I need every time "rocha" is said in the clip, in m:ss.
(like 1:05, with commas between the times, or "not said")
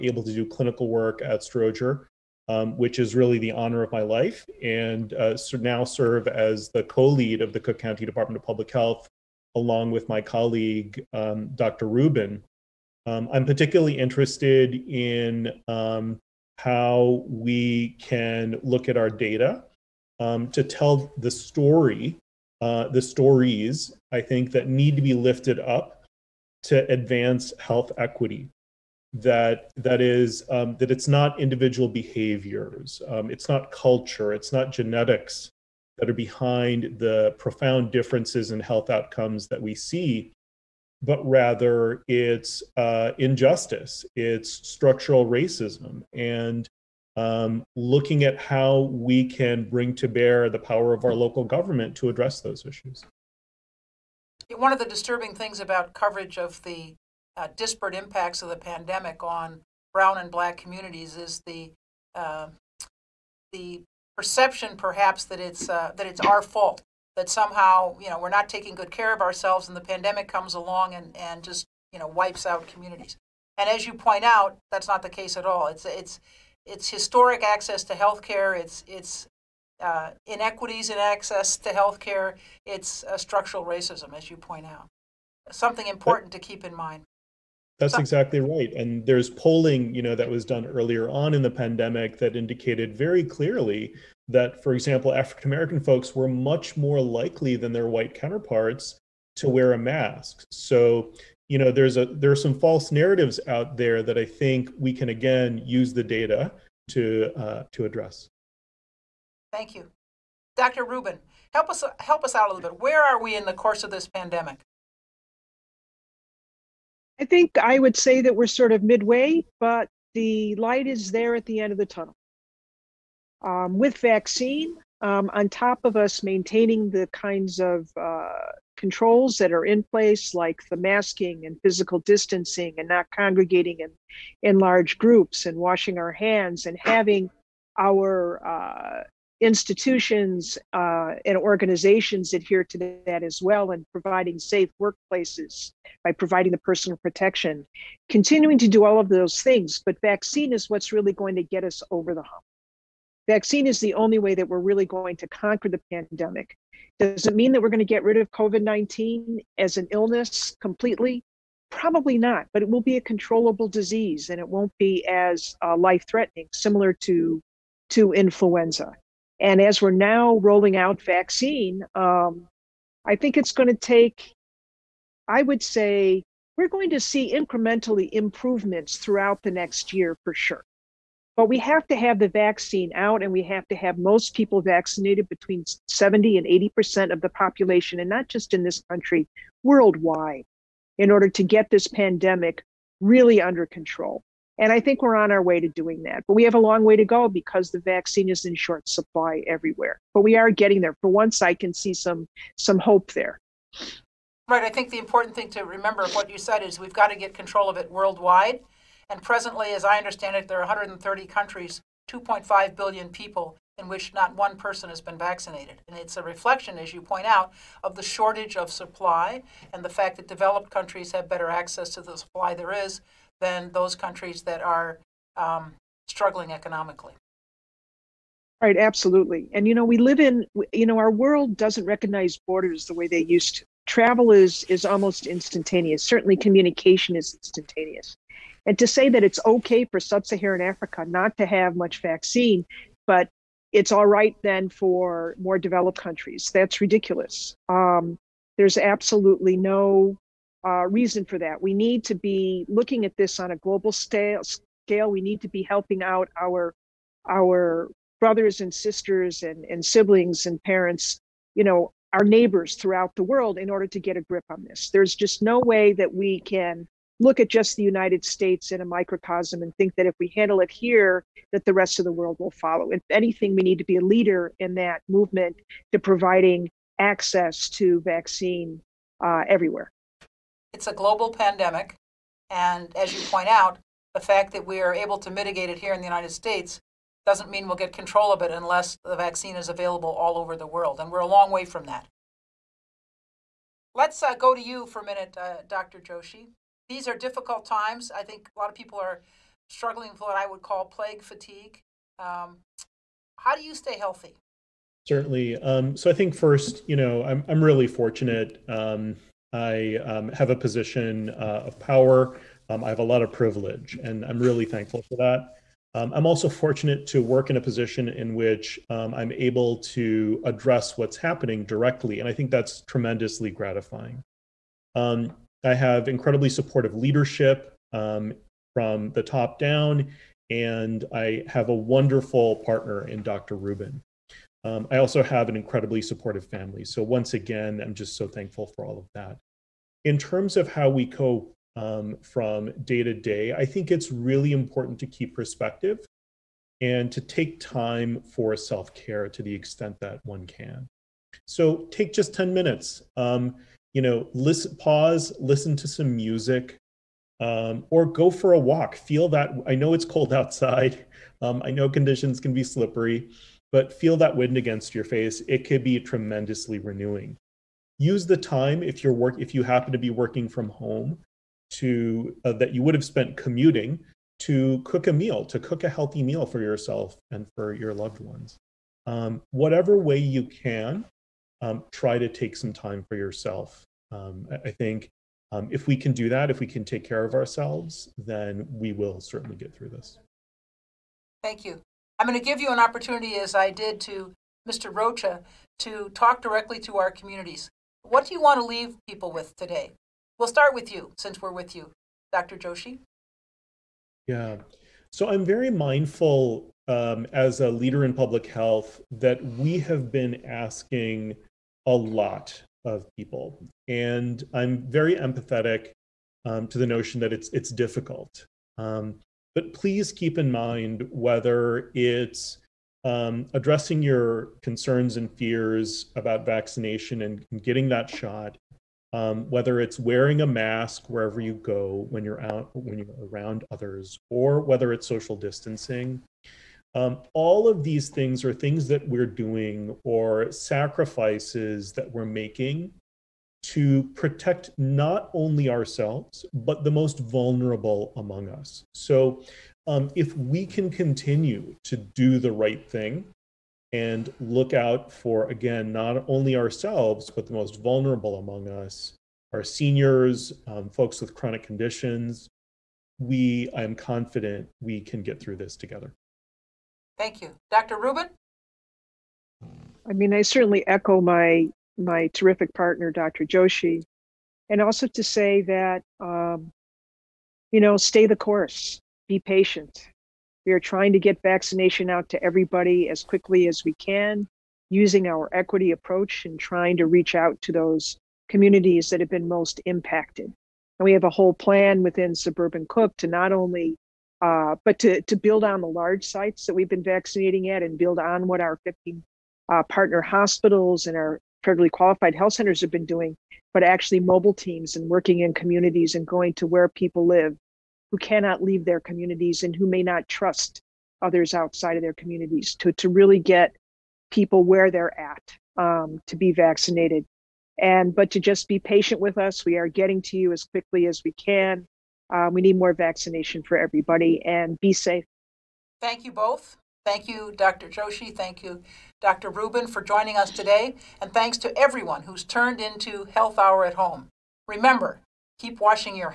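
6:34.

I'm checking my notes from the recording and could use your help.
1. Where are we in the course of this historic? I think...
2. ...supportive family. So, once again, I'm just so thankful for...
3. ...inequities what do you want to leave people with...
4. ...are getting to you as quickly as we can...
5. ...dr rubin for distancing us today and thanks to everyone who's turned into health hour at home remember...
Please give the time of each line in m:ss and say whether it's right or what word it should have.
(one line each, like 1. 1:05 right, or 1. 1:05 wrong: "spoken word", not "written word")
1. 1:52 wrong: "pandemic", not "historic"
2. 5:36 right
3. 6:37 wrong: "communities", not "inequities"
4. 8:39 right
5. 8:49 wrong: "joining", not "distancing".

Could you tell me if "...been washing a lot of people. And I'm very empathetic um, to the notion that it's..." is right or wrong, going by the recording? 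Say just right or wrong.
wrong.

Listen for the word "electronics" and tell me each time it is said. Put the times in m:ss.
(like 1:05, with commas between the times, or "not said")
not said.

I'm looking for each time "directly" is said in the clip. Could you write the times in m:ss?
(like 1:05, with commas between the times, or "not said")
5:21, 6:36.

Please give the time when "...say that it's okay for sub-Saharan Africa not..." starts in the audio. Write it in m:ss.
3:58.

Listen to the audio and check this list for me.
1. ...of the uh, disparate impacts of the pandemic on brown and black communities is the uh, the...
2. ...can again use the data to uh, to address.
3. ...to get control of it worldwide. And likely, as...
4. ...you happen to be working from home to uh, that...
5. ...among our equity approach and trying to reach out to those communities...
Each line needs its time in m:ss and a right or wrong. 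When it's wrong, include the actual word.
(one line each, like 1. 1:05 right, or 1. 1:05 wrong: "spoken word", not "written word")
1. 0:56 right
2. 1:44 right
3. 3:27 wrong: "presently", not "likely"
4. 6:09 right
5. 8:04 wrong: "using", not "among".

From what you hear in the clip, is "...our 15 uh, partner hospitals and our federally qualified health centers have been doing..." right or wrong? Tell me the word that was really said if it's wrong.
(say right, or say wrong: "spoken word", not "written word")
right.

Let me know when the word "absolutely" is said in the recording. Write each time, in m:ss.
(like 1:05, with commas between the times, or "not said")
3:48, 4:08.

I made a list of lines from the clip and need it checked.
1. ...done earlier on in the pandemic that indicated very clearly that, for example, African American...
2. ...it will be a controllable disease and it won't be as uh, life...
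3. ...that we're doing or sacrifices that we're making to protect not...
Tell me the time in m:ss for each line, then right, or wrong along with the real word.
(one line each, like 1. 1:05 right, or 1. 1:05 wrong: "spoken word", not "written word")
1. 1:30 right
2. 2:42 right
3. 7:18 right.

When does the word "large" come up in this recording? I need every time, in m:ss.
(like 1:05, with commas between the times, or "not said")
2:14, 8:15.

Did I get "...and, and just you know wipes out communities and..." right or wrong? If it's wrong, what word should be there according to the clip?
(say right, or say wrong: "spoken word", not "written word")
right.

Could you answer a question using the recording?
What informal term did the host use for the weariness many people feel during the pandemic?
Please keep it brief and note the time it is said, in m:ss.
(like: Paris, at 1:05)
Plague fatigue, at 5:00.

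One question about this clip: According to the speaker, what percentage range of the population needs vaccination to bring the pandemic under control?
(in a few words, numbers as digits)
70 to 80%.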